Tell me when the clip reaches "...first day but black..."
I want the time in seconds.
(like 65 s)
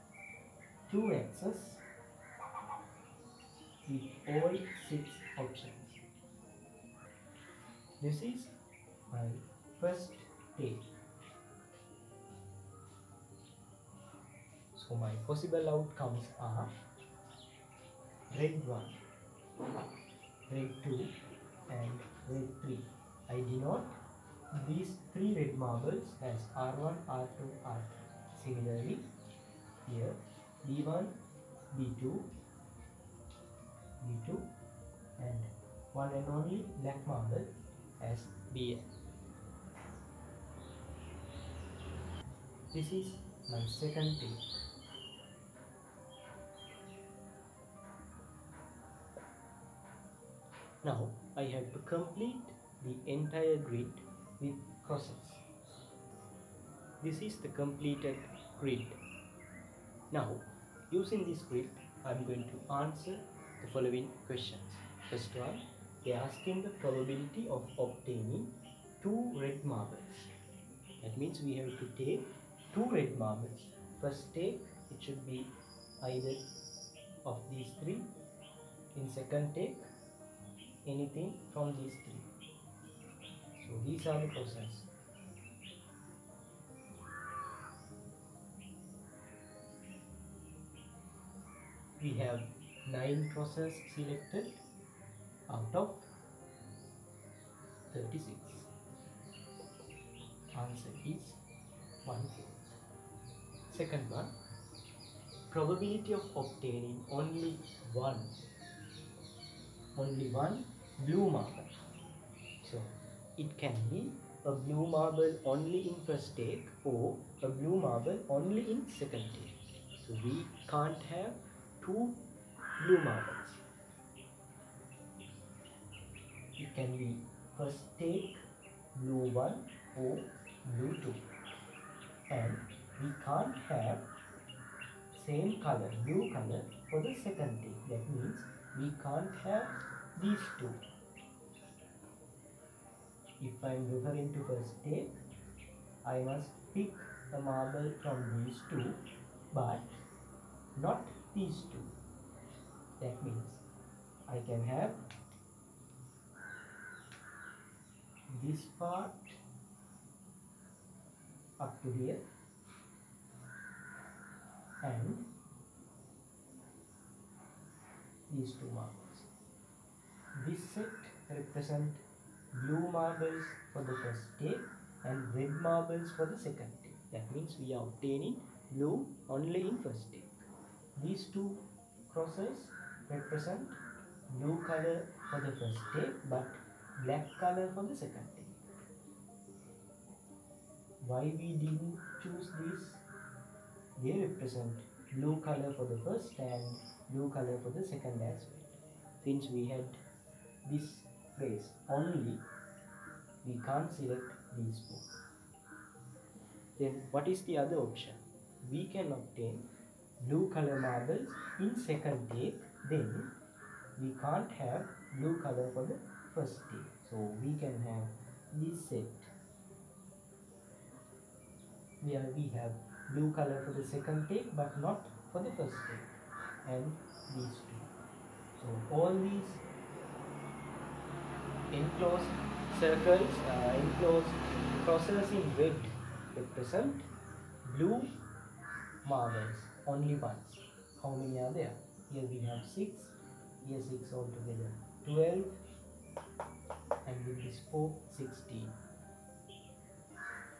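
185 s.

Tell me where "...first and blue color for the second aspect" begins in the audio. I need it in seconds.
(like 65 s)
195 s.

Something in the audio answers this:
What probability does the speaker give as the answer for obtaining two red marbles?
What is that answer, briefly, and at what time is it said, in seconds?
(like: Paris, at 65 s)
1/4, at 102 s.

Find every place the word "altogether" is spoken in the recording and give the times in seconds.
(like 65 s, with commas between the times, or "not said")
244 s.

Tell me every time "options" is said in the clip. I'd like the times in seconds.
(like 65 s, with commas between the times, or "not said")
5 s, 207 s.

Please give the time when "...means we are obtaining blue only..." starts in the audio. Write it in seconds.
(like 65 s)
177 s.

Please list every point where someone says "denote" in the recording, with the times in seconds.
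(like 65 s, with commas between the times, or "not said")
23 s.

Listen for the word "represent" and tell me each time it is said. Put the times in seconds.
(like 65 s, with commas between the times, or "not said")
171 s, 183 s, 194 s, 236 s.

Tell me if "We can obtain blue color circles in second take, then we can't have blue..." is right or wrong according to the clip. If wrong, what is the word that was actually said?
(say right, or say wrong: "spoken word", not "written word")
wrong: "marbles", not "circles".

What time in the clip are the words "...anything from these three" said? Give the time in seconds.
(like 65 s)
80 s.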